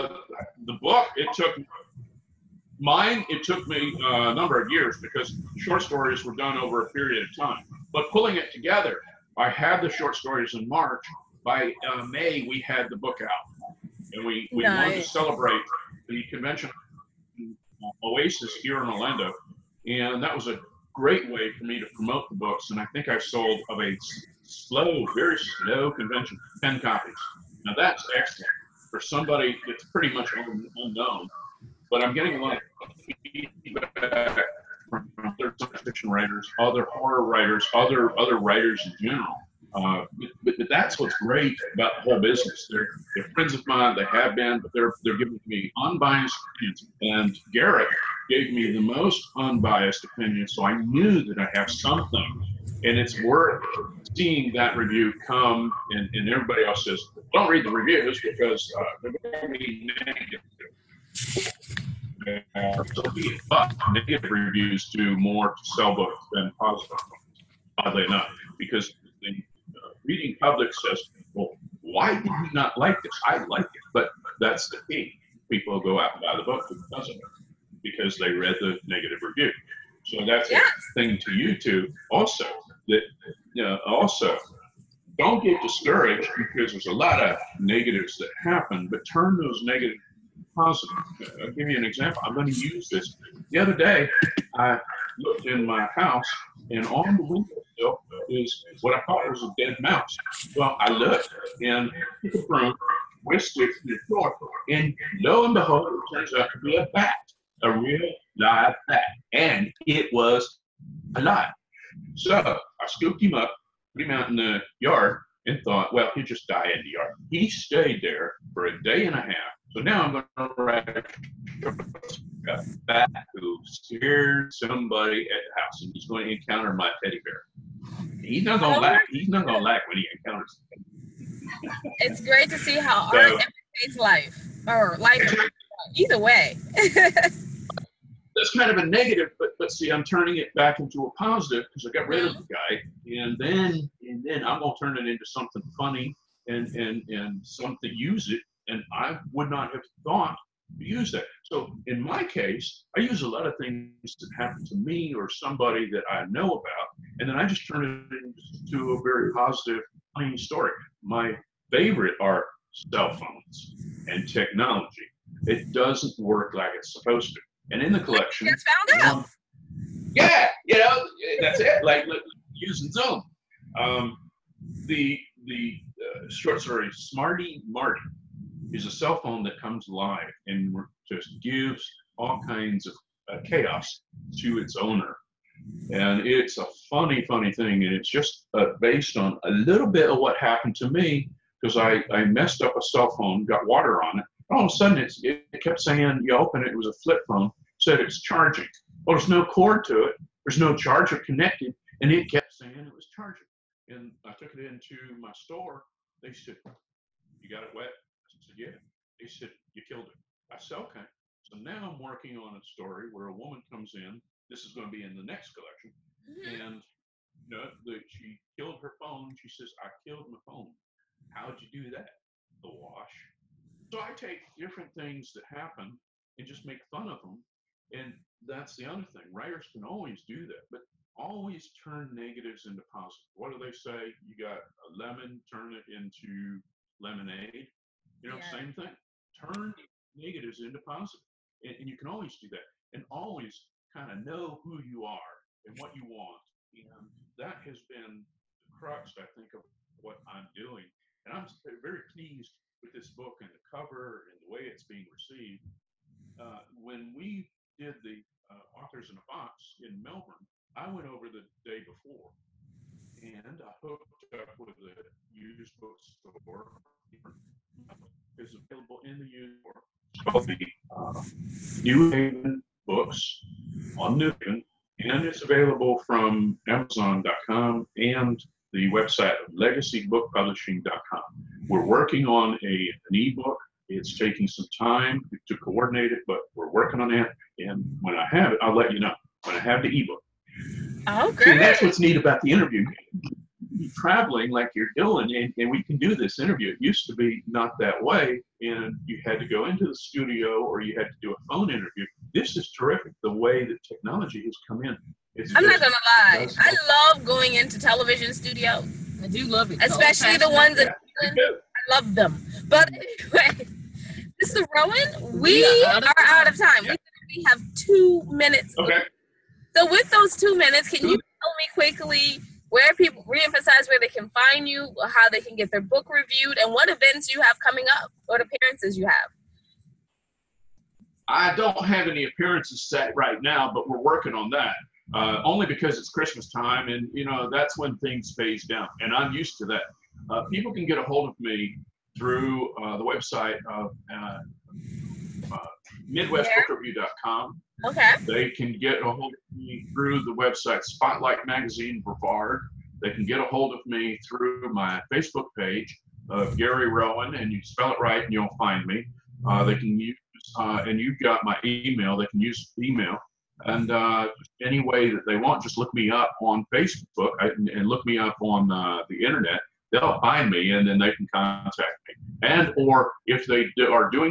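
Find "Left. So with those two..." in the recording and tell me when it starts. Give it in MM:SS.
05:18.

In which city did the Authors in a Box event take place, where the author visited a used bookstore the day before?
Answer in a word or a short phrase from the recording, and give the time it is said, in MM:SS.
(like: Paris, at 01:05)
Melbourne, at 04:20.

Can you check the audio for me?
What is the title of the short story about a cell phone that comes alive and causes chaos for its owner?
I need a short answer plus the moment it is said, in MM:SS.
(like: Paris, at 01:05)
Smarty Marty, at 02:56.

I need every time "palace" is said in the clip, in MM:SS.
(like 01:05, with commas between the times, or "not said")
not said.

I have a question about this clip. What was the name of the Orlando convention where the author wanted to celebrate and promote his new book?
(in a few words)
Oasis.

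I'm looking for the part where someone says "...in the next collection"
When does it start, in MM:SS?
03:35.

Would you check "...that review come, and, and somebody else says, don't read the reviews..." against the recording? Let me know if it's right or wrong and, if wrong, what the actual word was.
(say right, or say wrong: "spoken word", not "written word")
wrong: "everybody", not "somebody".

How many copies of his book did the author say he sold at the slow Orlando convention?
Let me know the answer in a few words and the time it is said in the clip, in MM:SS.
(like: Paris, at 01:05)
10, at 00:26.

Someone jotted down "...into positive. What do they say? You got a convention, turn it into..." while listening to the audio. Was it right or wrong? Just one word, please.
wrong.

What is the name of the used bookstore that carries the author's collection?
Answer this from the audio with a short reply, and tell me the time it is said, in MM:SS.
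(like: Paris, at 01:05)
New Haven Books, at 04:31.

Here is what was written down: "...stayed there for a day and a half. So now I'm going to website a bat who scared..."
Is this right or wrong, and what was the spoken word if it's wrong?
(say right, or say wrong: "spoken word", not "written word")
wrong: "write", not "website".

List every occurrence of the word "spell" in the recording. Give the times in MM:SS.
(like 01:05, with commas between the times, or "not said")
05:57.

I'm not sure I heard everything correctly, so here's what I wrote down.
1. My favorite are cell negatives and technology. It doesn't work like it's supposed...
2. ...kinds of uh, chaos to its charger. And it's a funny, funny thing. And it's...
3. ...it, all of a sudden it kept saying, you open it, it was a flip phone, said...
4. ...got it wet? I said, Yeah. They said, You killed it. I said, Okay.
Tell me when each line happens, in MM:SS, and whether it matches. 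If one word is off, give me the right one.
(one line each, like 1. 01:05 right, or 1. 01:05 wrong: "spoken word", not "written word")
1. 02:41 wrong: "phones", not "negatives"
2. 03:02 wrong: "owner", not "charger"
3. 03:14 right
4. 03:27 right.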